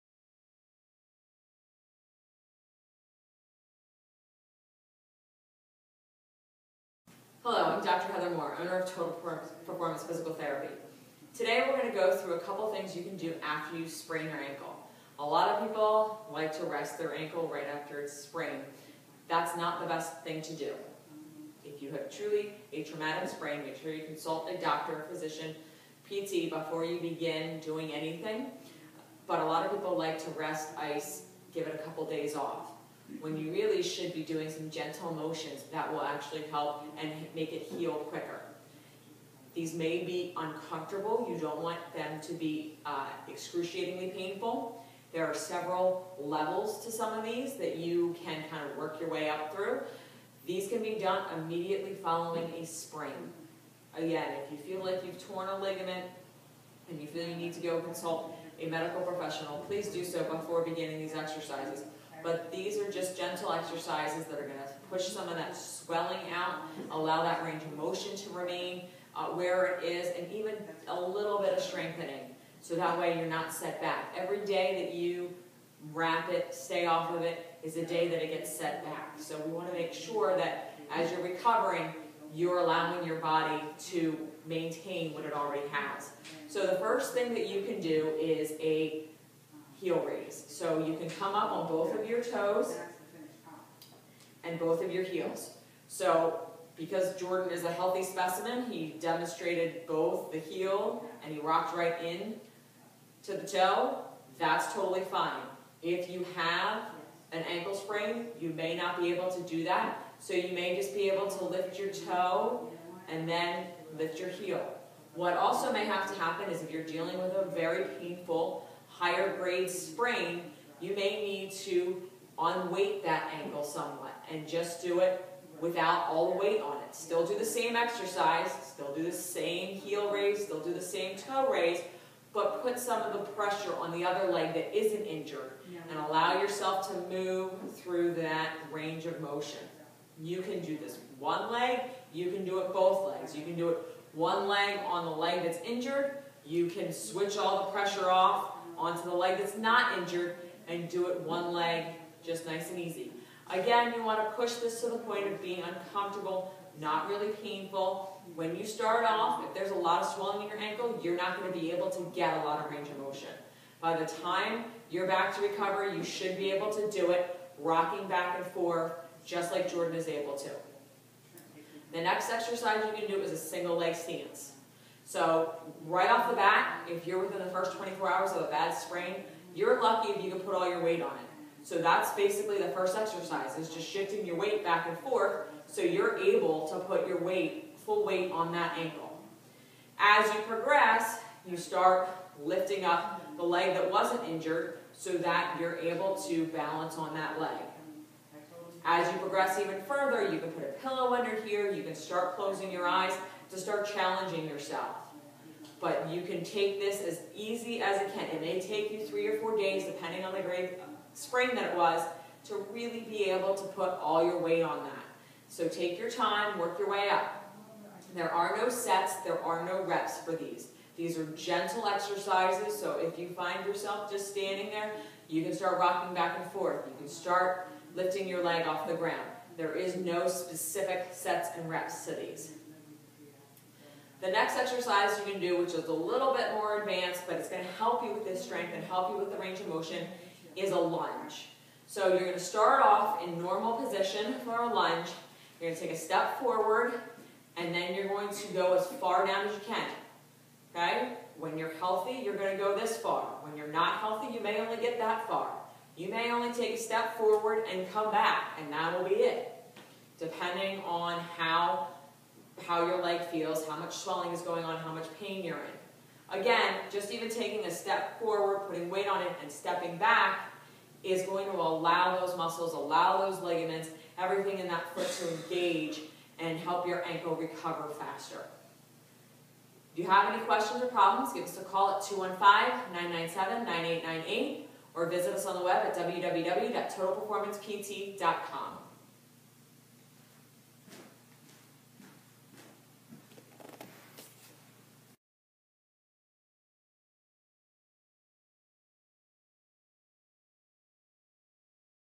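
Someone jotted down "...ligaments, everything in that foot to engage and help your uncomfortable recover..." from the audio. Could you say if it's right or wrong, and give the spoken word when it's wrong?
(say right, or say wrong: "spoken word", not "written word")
wrong: "ankle", not "uncomfortable".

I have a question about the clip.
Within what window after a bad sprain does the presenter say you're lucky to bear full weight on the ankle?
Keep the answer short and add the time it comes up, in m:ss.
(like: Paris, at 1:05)
first 24 hours, at 2:57.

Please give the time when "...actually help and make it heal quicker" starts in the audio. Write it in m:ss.
0:36.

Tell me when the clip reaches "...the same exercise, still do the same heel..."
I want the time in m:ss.
2:07.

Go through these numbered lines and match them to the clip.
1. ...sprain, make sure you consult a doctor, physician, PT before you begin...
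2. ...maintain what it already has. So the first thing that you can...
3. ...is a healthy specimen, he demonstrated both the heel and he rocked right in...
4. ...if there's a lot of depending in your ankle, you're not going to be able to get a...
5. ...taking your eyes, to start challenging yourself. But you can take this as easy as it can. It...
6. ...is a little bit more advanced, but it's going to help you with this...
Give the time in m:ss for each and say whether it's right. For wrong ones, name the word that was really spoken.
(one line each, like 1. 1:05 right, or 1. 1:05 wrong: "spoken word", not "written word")
1. 0:23 right
2. 1:24 right
3. 1:37 right
4. 2:39 wrong: "swelling", not "depending"
5. 3:22 wrong: "closing", not "taking"
6. 3:55 right.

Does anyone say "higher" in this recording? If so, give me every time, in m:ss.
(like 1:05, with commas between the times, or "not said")
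1:58.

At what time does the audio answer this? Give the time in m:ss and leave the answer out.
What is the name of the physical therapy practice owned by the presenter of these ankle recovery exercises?
0:08.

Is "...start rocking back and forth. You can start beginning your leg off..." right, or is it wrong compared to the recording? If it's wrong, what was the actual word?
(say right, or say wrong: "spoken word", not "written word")
wrong: "lifting", not "beginning".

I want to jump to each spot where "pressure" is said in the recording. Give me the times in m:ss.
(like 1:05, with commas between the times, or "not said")
2:13, 2:27.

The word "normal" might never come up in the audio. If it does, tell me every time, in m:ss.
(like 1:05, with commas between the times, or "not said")
4:03.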